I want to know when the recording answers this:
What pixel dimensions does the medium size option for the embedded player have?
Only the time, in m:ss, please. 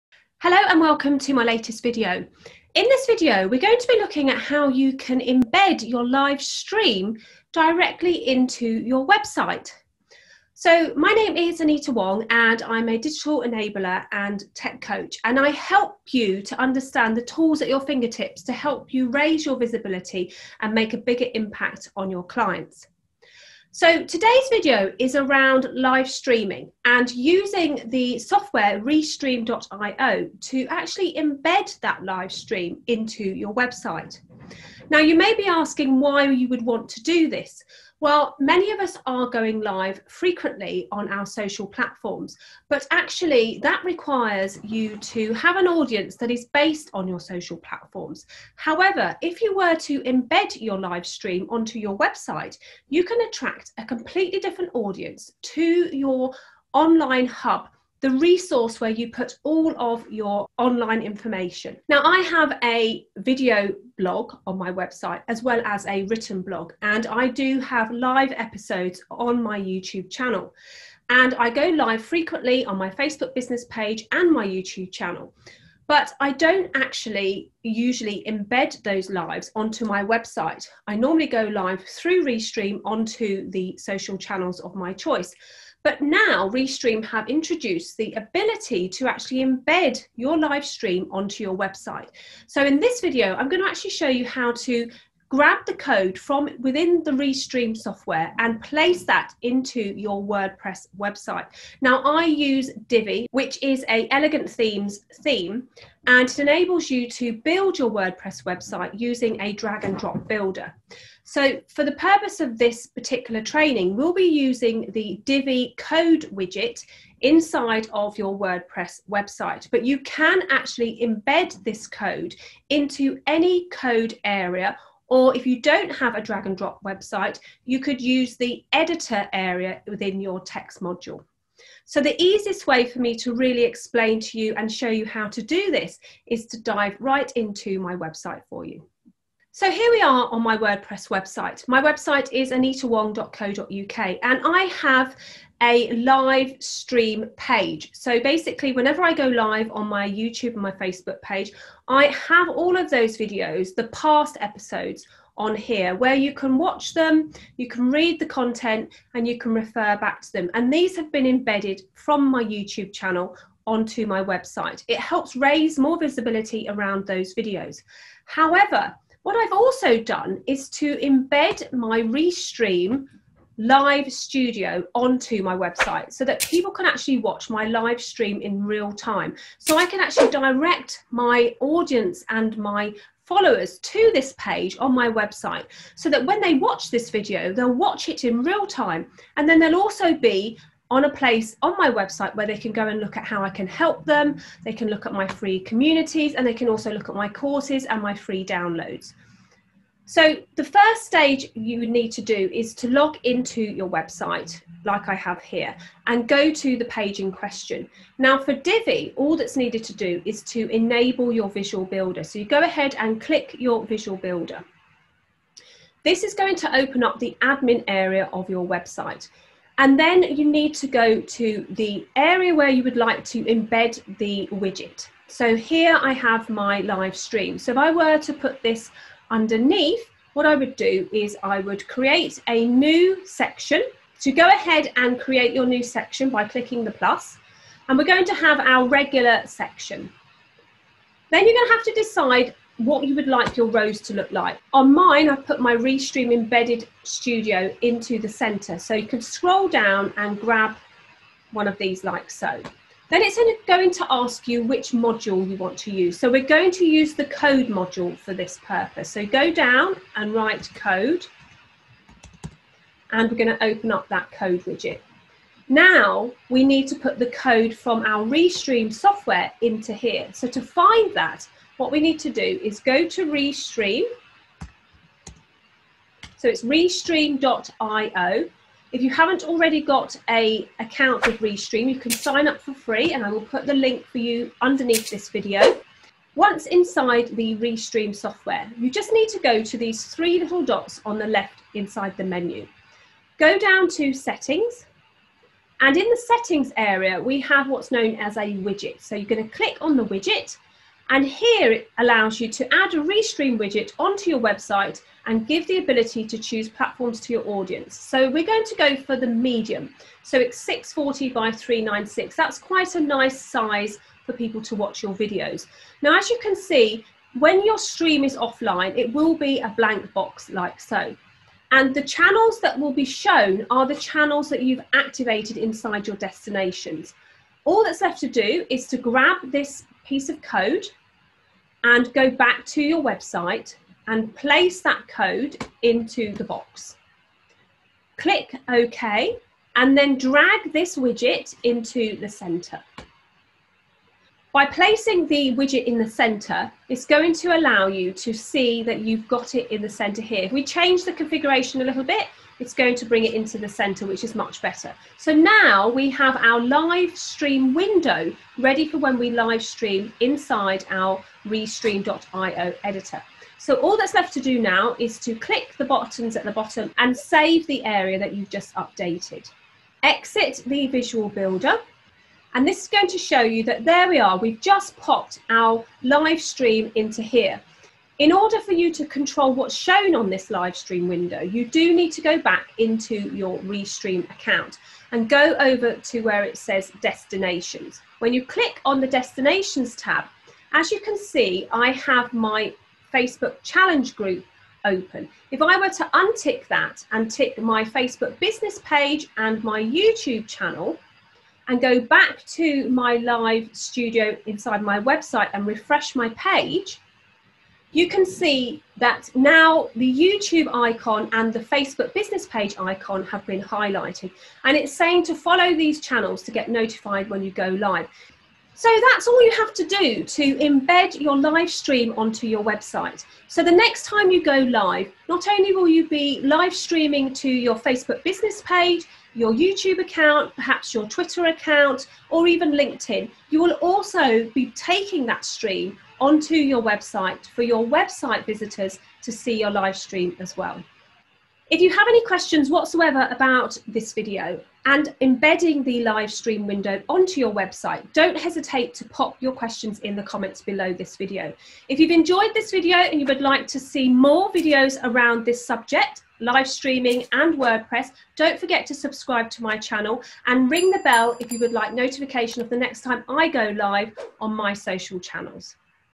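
5:10.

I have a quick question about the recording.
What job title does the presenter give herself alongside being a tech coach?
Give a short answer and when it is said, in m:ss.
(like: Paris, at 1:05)
Digital enabler, at 0:12.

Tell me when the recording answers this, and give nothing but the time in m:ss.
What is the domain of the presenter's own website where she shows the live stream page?
2:22.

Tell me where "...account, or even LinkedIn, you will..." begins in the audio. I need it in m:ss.
7:11.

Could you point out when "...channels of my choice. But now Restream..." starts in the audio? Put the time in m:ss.
1:24.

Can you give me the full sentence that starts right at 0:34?
Now you may be asking why you would want to do this.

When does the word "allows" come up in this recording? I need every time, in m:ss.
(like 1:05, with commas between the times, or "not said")
5:01, 5:47.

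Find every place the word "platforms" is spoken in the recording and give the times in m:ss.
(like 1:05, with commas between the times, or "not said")
0:41, 0:47, 5:06.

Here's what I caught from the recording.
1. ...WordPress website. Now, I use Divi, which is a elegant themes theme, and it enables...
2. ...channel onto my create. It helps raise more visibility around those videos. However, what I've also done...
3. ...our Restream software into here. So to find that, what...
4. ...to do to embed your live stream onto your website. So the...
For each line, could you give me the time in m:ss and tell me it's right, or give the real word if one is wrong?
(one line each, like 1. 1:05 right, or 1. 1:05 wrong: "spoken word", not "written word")
1. 1:40 right
2. 2:42 wrong: "website", not "create"
3. 4:28 right
4. 6:59 right.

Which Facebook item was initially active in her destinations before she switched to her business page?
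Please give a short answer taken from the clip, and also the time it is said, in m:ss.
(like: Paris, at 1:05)
Facebook challenge group, at 6:33.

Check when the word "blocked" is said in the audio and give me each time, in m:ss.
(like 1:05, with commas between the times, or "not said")
not said.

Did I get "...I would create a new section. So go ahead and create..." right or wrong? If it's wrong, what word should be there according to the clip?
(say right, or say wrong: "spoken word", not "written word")
right.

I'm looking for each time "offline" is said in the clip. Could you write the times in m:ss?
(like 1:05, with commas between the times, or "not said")
5:18.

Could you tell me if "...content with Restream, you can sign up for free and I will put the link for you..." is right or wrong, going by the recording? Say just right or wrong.
wrong.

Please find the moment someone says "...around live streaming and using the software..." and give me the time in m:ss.
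0:25.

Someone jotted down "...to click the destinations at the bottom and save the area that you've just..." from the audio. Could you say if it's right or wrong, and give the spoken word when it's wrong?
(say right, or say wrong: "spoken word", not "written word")
wrong: "buttons", not "destinations".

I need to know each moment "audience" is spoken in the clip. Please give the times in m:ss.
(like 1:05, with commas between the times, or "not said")
0:45, 0:54, 3:01, 5:07.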